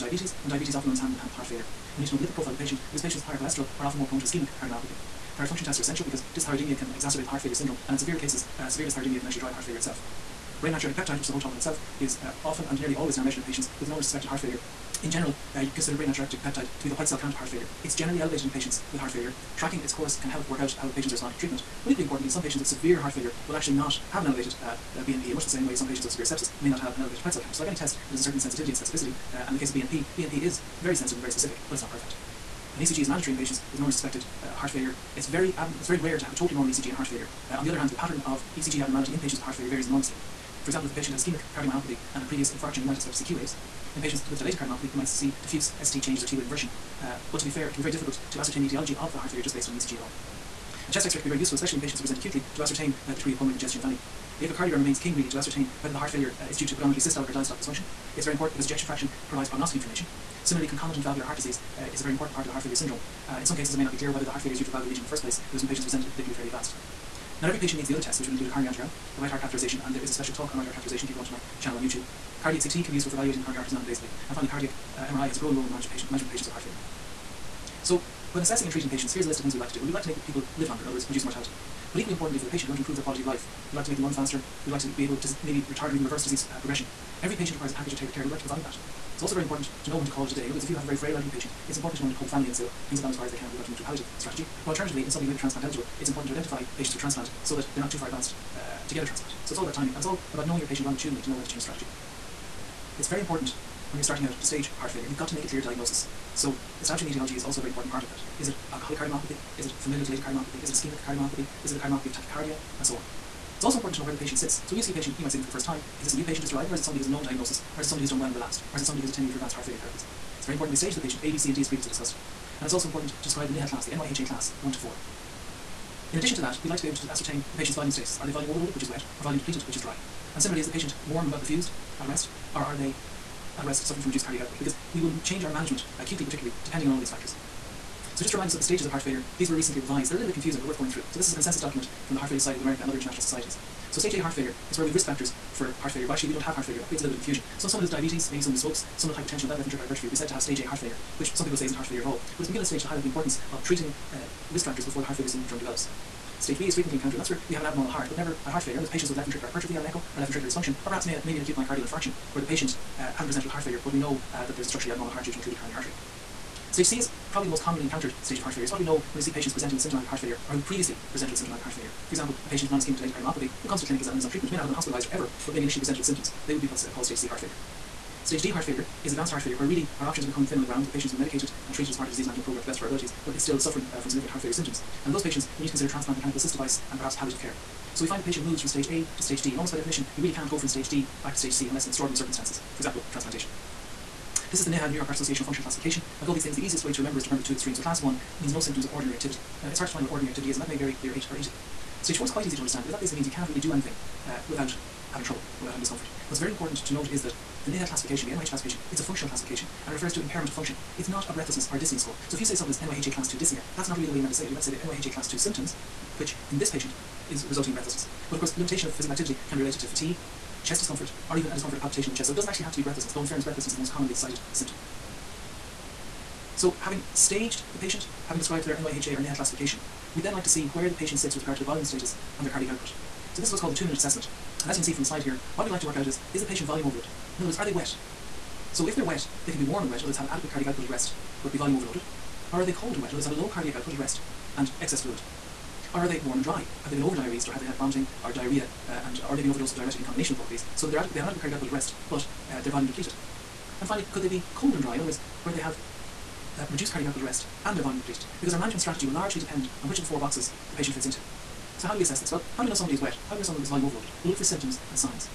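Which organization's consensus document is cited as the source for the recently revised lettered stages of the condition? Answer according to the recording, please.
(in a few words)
Heart Failure Society of America.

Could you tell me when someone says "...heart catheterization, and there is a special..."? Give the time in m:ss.
1:09.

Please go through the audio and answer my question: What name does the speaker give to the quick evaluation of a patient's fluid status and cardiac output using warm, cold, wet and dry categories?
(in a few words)
Two-minute assessment.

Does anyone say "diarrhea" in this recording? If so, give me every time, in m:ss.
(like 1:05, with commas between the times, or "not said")
4:08.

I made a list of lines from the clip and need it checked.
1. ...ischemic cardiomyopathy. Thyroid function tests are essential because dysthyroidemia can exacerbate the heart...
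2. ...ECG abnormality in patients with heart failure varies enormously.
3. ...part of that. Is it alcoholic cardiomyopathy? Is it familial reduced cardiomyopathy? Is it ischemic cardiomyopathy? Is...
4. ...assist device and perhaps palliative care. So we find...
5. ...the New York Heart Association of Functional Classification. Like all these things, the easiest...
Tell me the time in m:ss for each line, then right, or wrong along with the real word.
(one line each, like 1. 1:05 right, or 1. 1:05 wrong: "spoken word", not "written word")
1. 0:04 right
2. 0:38 right
3. 1:47 wrong: "dilated", not "reduced"
4. 3:06 right
5. 3:14 right.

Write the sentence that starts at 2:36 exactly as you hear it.
Stage B is frequently encountered, and that's where we have an abnormal heart but never had heart failure.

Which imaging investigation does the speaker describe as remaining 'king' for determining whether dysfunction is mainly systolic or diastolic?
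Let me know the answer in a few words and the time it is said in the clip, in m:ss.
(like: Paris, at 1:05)
Echocardiogram, at 0:54.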